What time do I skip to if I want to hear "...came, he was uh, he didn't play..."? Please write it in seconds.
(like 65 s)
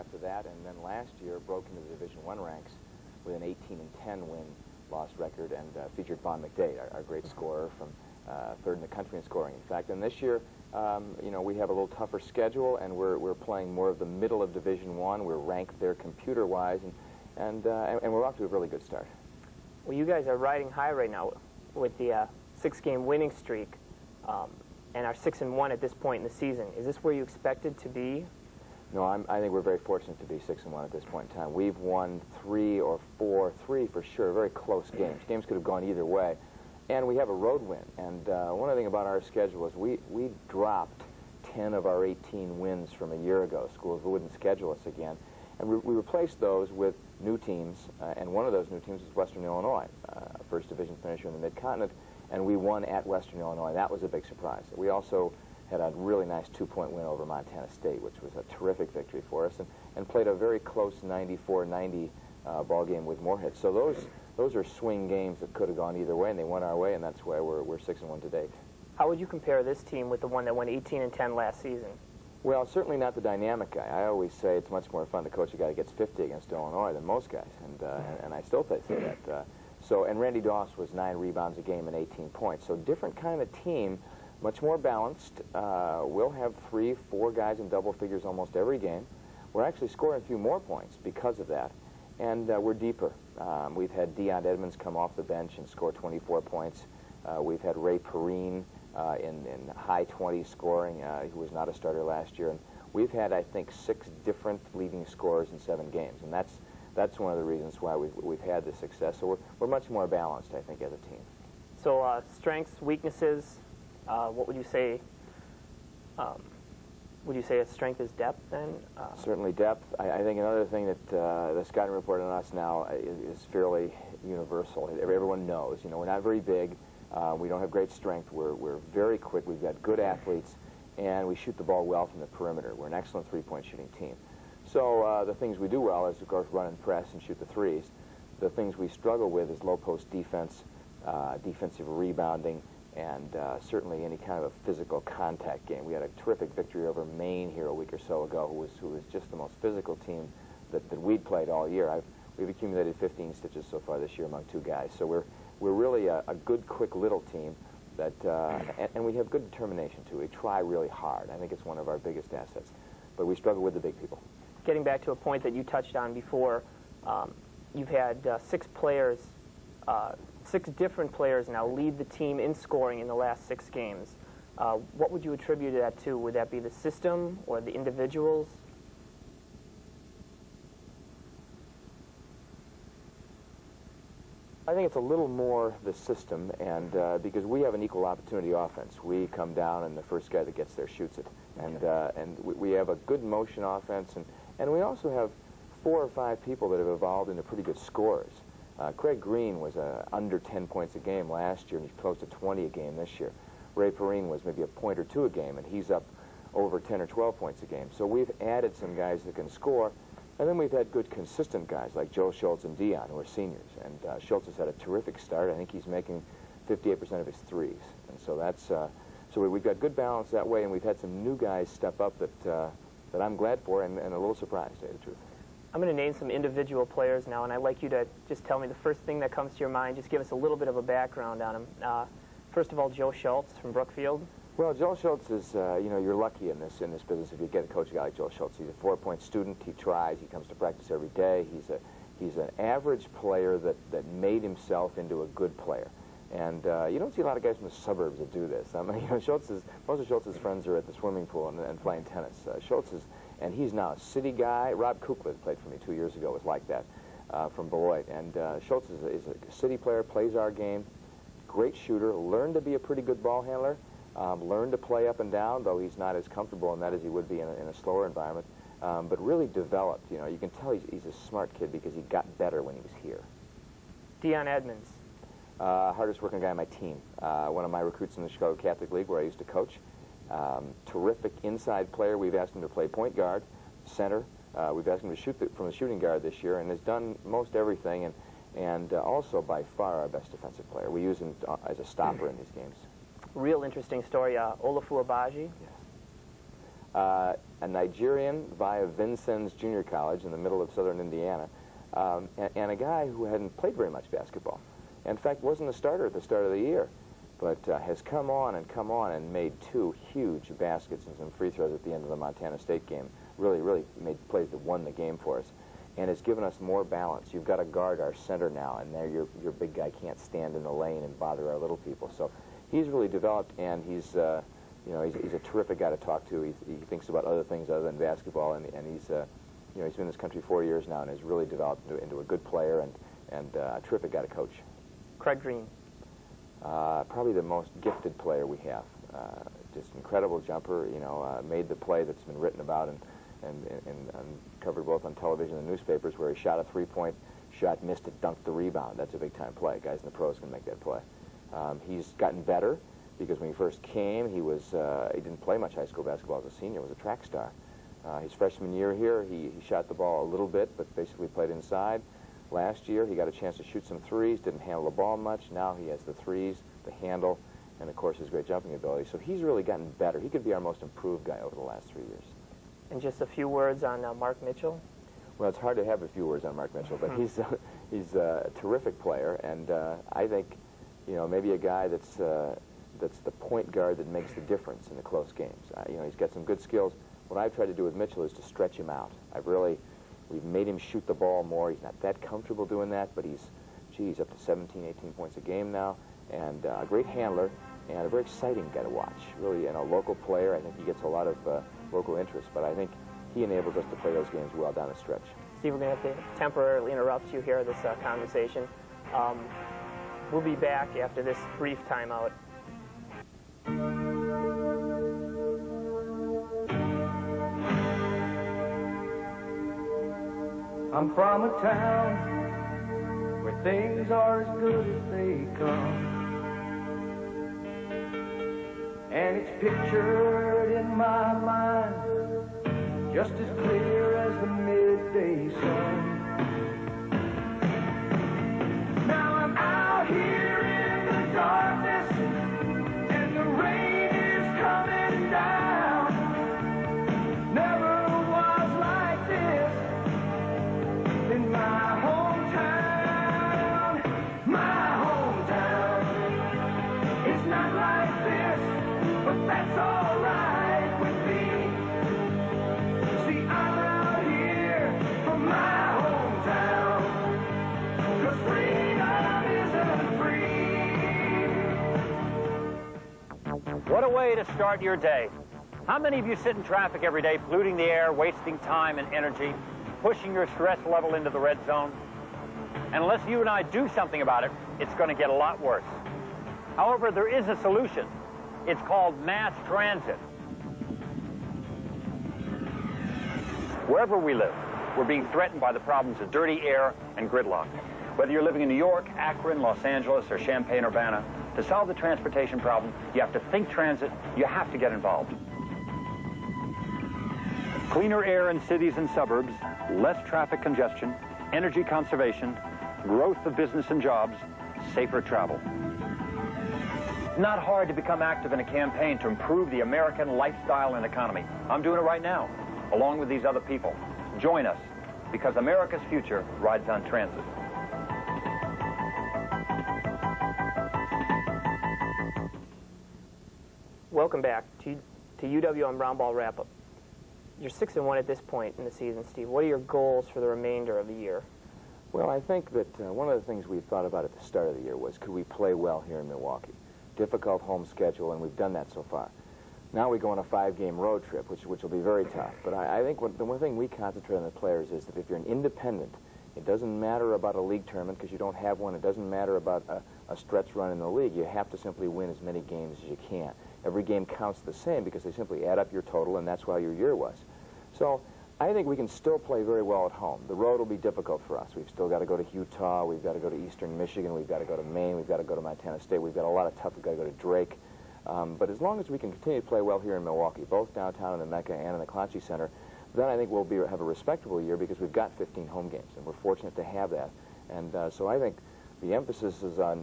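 353 s.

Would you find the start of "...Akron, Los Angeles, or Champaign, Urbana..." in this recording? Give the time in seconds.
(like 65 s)
499 s.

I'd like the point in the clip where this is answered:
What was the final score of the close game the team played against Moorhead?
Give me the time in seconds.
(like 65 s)
61 s.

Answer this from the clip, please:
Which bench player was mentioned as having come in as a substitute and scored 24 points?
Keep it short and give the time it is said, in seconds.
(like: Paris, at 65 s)
Deion Edmonds, at 94 s.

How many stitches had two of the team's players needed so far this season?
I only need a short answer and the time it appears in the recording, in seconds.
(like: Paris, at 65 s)
15, at 152 s.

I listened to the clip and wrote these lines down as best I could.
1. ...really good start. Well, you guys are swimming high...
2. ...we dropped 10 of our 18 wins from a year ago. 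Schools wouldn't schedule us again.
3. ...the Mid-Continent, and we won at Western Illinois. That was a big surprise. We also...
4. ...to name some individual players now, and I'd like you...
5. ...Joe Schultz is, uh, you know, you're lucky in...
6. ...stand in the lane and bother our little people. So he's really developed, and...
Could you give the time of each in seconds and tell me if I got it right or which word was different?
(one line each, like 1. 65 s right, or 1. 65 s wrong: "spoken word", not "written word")
1. 18 s wrong: "riding", not "swimming"
2. 40 s right
3. 51 s right
4. 225 s right
5. 234 s right
6. 320 s right.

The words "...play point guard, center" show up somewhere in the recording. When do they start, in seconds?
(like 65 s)
282 s.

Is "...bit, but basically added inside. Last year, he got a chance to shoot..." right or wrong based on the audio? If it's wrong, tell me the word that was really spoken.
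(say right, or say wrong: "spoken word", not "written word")
wrong: "played", not "added".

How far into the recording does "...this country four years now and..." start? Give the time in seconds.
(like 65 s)
330 s.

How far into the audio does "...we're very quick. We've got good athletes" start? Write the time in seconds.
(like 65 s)
128 s.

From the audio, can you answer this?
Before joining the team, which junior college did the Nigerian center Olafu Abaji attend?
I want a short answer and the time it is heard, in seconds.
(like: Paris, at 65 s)
Vincennes Junior College, at 298 s.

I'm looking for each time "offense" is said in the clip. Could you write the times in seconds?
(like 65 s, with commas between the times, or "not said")
188 s, 193 s.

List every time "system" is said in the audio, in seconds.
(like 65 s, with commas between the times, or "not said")
176 s, 185 s.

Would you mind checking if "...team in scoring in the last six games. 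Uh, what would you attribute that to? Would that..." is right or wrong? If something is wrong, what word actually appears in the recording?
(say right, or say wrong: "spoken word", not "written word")
right.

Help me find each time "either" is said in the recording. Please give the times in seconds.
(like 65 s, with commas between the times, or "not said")
35 s, 65 s.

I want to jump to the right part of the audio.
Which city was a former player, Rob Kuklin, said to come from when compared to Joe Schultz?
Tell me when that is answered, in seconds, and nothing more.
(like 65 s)
257 s.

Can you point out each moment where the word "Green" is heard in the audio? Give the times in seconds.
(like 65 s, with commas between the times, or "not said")
199 s, 335 s.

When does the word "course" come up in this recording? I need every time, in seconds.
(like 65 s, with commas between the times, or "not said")
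136 s, 367 s.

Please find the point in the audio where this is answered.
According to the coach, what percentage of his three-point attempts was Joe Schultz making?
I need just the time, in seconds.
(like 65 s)
216 s.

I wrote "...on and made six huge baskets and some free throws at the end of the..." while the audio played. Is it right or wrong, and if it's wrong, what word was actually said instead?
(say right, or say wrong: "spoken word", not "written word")
wrong: "two", not "six".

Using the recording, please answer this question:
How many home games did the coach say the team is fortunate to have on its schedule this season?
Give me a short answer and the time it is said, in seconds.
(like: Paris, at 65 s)
15, at 585 s.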